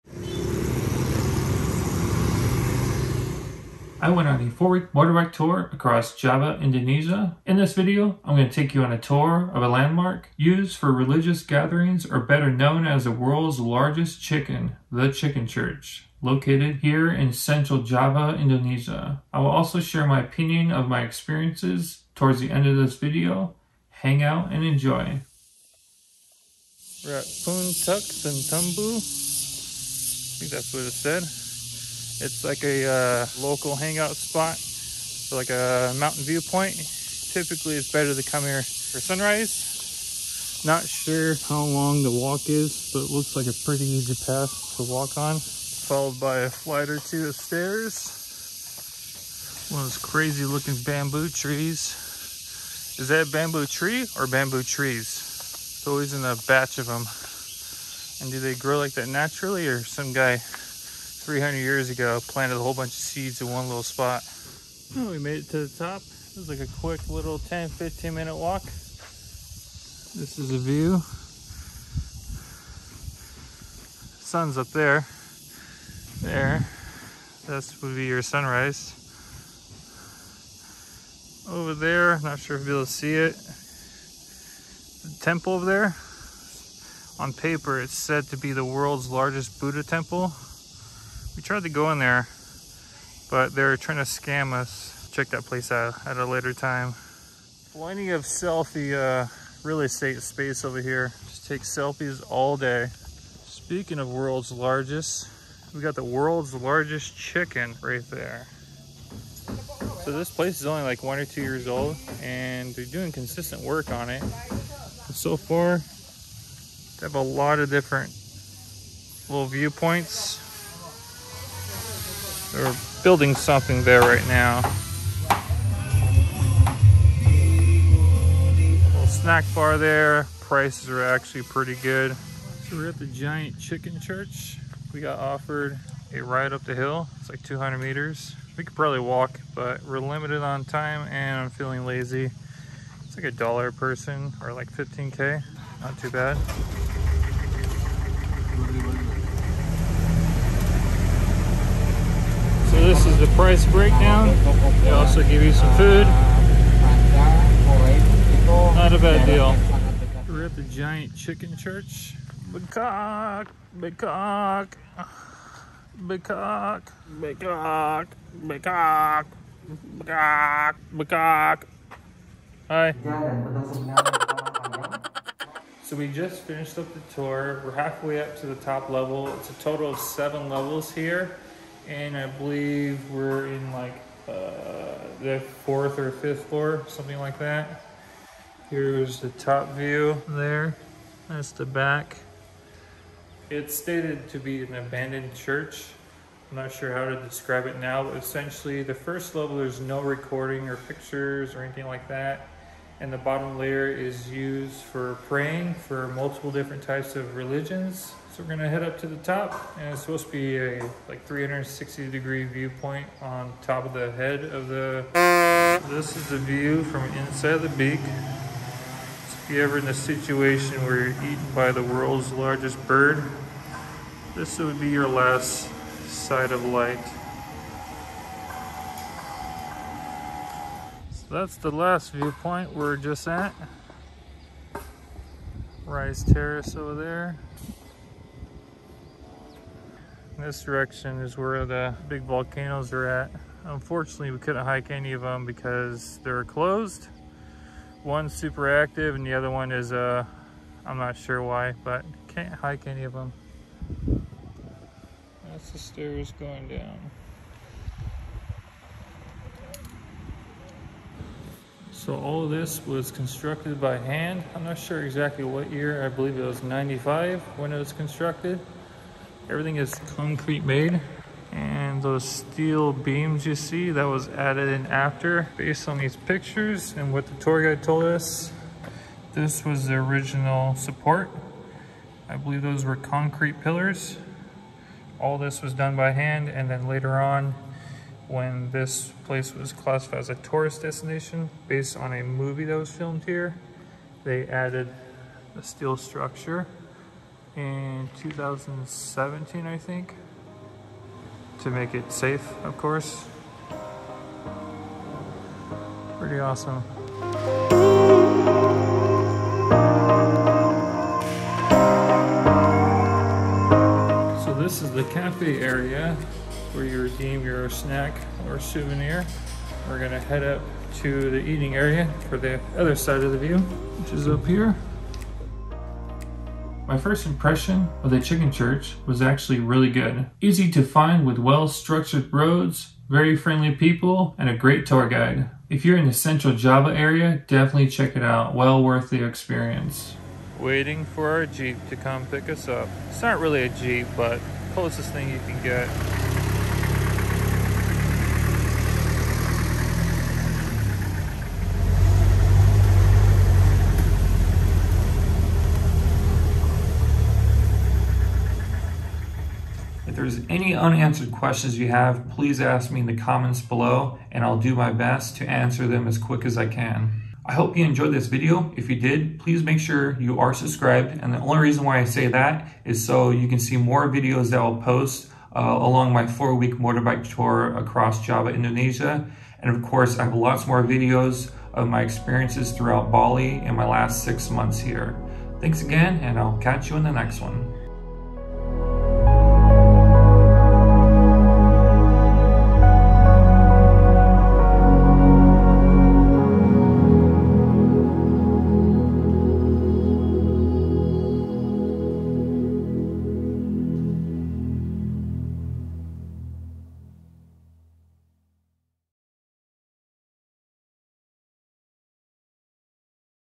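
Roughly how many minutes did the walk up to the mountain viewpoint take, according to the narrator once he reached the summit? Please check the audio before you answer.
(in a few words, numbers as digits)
10 to 15 minutes.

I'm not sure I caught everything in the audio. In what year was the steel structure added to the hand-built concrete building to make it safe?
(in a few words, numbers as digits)
2017.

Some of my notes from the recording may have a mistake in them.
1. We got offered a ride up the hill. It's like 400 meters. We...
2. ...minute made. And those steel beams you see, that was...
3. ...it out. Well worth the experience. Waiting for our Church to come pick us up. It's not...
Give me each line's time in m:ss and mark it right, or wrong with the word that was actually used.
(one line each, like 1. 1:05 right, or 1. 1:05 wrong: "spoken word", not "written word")
1. 2:14 wrong: "200", not "400"
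2. 4:30 wrong: "concrete", not "minute"
3. 5:38 wrong: "Jeep", not "Church".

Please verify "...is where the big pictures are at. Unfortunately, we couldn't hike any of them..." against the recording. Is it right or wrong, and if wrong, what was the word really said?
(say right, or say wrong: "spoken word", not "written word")
wrong: "volcanoes", not "pictures".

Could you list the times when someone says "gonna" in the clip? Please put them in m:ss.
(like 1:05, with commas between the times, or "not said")
3:28, 5:19.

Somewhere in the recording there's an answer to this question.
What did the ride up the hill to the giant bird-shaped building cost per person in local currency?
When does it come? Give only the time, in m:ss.
2:24.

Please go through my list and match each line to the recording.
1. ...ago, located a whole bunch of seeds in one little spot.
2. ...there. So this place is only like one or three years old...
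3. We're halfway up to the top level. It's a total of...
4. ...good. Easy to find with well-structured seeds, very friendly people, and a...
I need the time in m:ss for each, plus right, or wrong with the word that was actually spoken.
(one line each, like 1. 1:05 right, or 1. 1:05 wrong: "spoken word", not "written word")
1. 1:01 wrong: "planted", not "located"
2. 1:48 wrong: "two", not "three"
3. 2:57 right
4. 5:29 wrong: "roads", not "seeds".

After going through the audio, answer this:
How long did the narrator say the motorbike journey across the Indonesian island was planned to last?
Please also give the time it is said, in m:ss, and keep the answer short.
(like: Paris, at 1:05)
4 weeks, at 0:04.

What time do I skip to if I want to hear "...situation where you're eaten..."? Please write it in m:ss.
3:39.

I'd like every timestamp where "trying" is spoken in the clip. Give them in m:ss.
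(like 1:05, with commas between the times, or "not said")
1:33.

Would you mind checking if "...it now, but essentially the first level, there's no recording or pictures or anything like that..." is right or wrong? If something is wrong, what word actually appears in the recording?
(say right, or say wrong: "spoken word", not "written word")
right.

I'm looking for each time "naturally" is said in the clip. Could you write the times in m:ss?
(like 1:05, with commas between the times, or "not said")
0:59.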